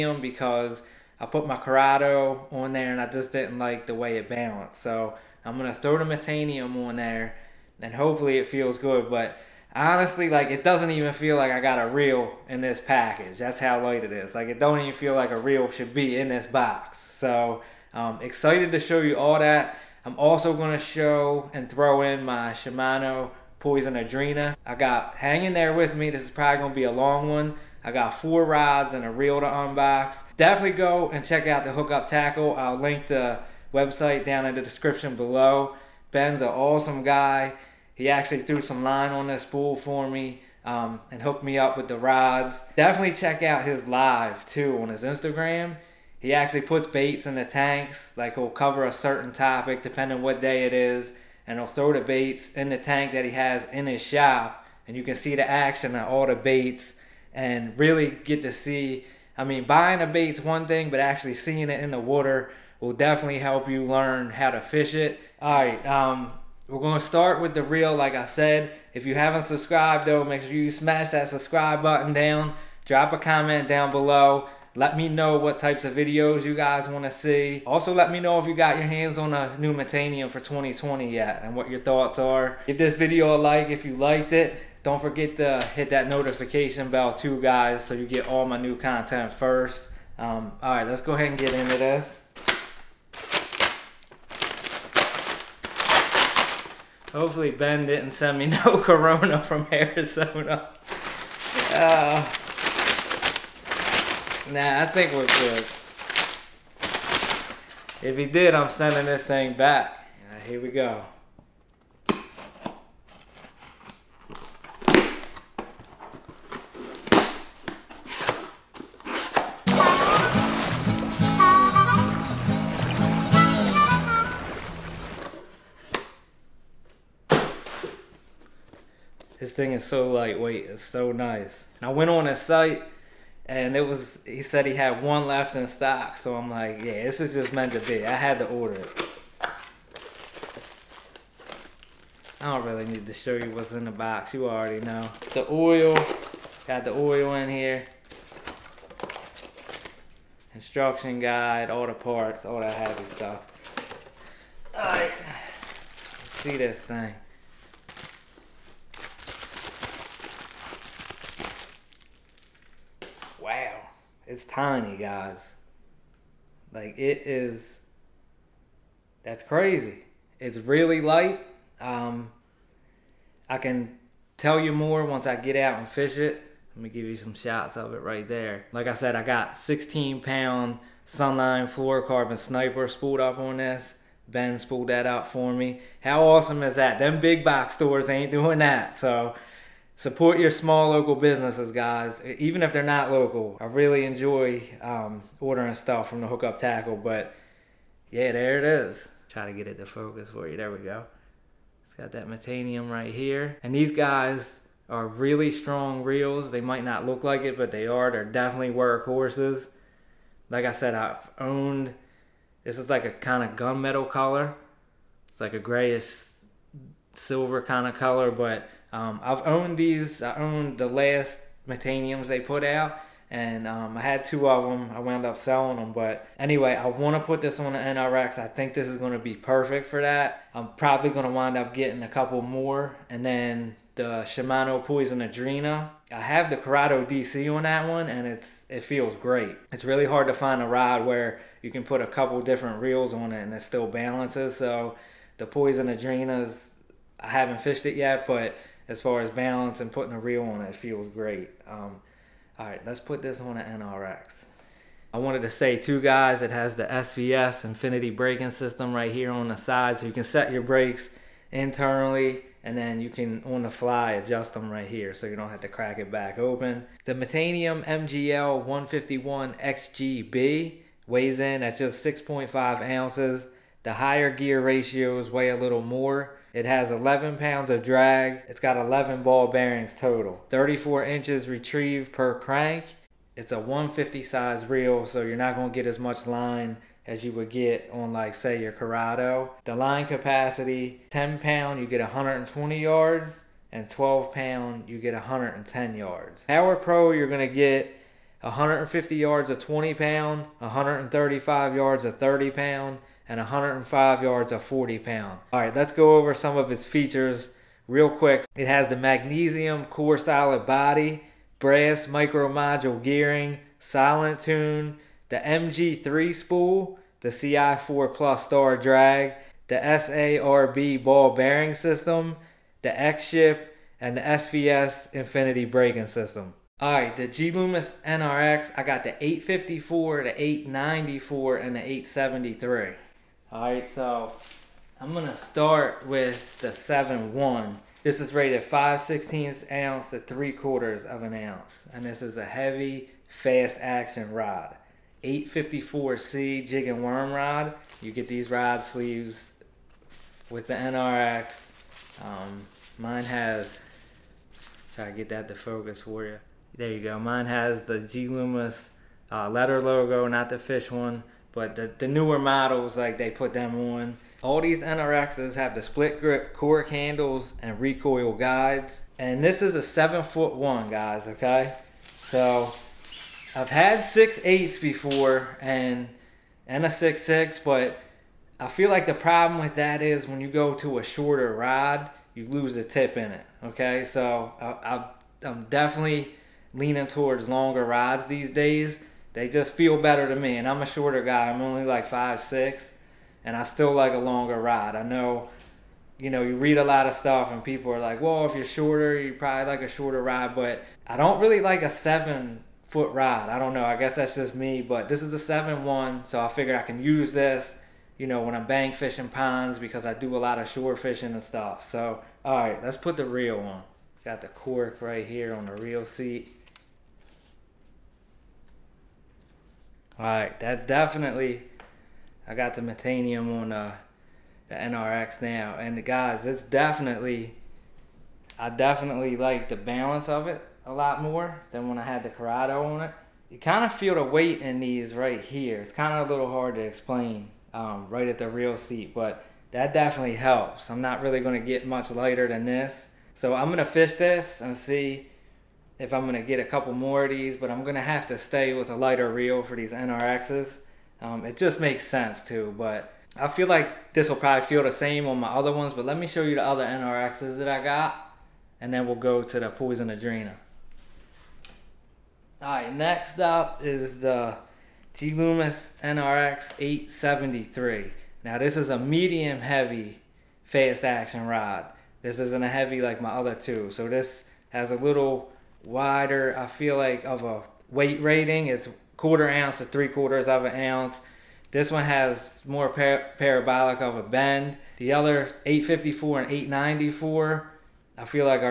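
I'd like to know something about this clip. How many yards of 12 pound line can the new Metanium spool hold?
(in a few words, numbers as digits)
110 yards.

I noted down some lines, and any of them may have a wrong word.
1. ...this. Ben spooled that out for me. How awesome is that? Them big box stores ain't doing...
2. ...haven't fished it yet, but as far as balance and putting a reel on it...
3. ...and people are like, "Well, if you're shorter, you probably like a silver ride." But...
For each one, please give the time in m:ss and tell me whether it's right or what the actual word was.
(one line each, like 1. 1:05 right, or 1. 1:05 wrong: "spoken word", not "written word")
1. 3:03 right
2. 4:07 right
3. 6:37 wrong: "shorter", not "silver".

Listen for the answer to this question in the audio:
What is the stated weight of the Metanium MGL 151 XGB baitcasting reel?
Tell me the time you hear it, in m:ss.
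4:32.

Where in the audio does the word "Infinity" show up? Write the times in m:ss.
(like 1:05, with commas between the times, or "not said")
4:17, 5:25.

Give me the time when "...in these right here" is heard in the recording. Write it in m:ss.
7:14.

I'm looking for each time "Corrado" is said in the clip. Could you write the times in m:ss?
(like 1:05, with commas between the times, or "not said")
0:01, 3:56, 4:48, 7:12.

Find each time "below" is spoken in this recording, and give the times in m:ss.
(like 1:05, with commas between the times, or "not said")
0:35, 1:13.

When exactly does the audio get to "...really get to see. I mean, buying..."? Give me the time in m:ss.
0:57.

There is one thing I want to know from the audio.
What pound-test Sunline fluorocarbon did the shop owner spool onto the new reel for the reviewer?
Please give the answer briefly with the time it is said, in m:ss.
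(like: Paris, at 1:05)
16 pound, at 2:59.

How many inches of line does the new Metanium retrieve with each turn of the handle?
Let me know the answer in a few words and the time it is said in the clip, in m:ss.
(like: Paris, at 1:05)
34 inches, at 4:40.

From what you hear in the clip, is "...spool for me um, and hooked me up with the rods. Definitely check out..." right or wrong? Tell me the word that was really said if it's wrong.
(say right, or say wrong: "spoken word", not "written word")
right.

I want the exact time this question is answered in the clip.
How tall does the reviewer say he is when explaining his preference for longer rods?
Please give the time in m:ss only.
6:32.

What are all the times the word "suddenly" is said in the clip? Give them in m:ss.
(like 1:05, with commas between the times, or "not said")
not said.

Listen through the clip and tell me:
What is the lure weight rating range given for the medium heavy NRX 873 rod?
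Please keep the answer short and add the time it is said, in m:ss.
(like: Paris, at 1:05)
1/4 to 3/4 ounce, at 7:59.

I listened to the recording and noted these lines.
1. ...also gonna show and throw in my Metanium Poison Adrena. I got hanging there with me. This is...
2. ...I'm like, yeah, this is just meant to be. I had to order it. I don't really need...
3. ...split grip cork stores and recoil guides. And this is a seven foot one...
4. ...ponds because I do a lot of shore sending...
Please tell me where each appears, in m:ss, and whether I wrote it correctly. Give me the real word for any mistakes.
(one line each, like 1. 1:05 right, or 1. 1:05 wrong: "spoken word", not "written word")
1. 0:20 wrong: "Shimano", not "Metanium"
2. 2:16 right
3. 6:05 wrong: "handles", not "stores"
4. 6:49 wrong: "fishing", not "sending".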